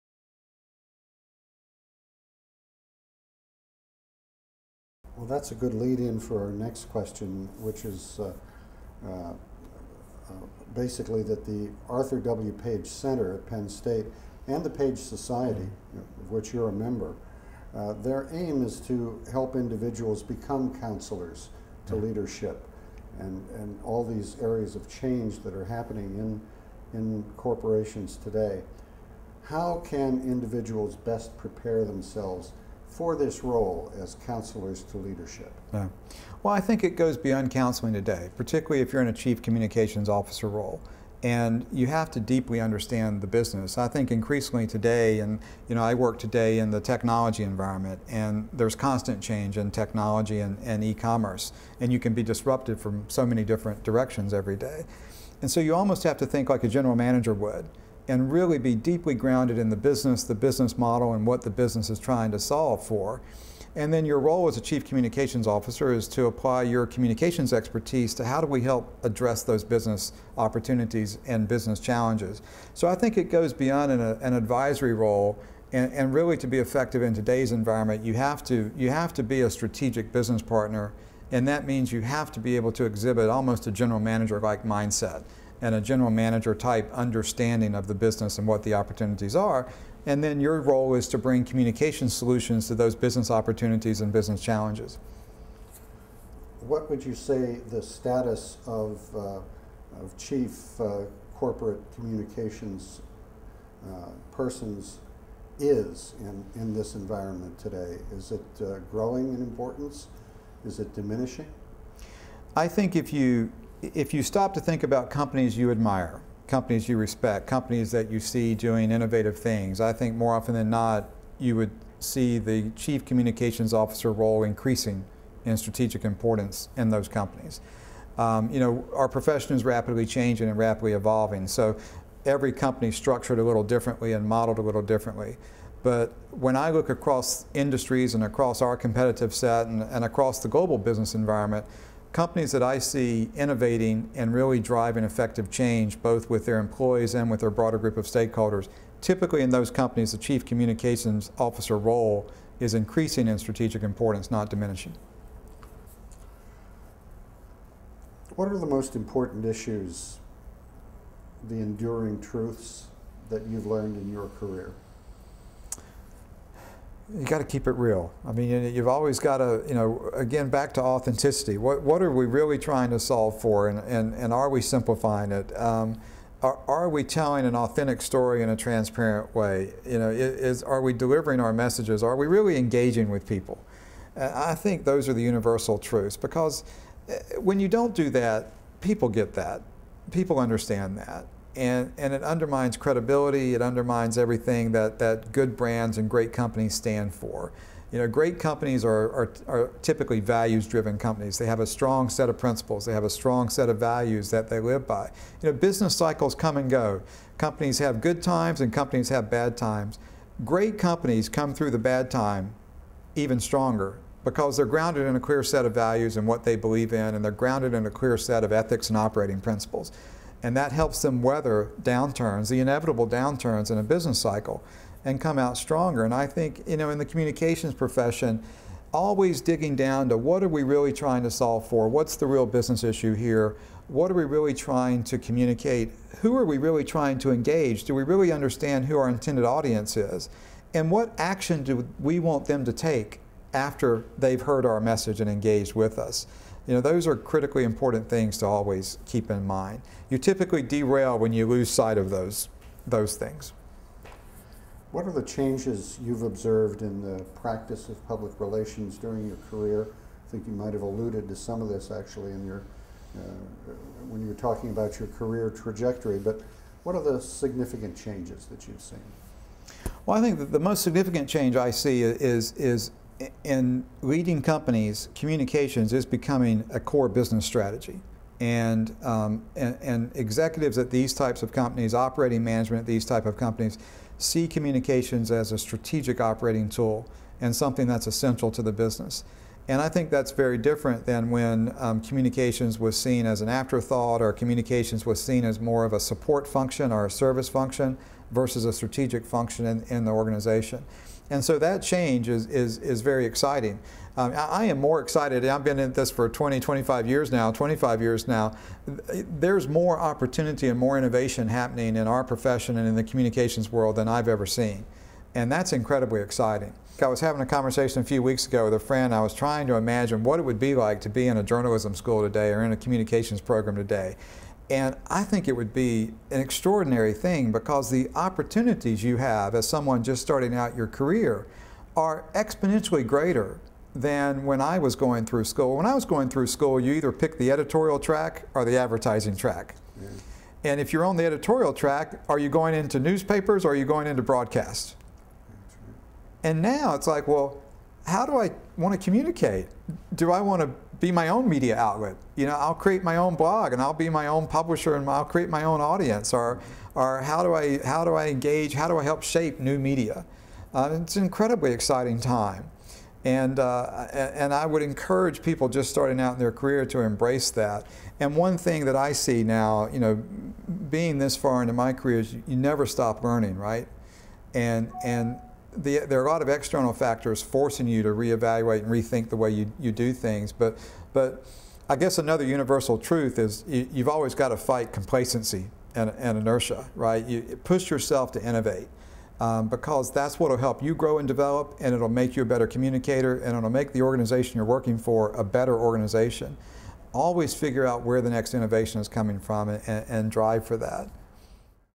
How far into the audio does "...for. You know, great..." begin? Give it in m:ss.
3:17.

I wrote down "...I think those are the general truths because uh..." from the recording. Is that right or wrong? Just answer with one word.
wrong.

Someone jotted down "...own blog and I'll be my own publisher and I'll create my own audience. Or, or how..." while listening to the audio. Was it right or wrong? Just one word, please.
right.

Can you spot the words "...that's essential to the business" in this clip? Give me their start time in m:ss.
4:47.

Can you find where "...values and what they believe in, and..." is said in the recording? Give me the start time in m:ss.
3:35.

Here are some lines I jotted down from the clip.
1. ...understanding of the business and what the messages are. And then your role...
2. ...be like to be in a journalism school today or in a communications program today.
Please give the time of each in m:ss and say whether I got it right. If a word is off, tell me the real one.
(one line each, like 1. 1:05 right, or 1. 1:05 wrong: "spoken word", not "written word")
1. 1:26 wrong: "opportunities", not "messages"
2. 5:20 right.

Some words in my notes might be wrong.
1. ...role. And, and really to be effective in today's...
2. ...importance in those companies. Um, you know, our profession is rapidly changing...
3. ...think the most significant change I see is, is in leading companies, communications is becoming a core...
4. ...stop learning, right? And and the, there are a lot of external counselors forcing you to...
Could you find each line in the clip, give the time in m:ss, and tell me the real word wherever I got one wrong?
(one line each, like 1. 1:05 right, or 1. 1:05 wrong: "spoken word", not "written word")
1. 1:14 right
2. 2:06 right
3. 4:30 right
4. 6:12 wrong: "factors", not "counselors".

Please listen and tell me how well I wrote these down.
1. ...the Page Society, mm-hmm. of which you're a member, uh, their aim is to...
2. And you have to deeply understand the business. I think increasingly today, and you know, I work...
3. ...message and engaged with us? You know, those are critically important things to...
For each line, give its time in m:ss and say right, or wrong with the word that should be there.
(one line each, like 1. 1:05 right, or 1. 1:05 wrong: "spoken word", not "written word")
1. 0:14 right
2. 0:41 right
3. 4:04 right.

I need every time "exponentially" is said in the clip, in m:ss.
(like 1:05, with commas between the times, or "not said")
5:32.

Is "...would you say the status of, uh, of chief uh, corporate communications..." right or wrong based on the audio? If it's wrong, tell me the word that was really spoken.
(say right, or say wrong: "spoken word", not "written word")
right.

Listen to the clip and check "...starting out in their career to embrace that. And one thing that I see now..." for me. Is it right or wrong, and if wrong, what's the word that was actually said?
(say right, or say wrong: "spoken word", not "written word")
right.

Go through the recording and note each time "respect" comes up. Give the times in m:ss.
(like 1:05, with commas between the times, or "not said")
1:56.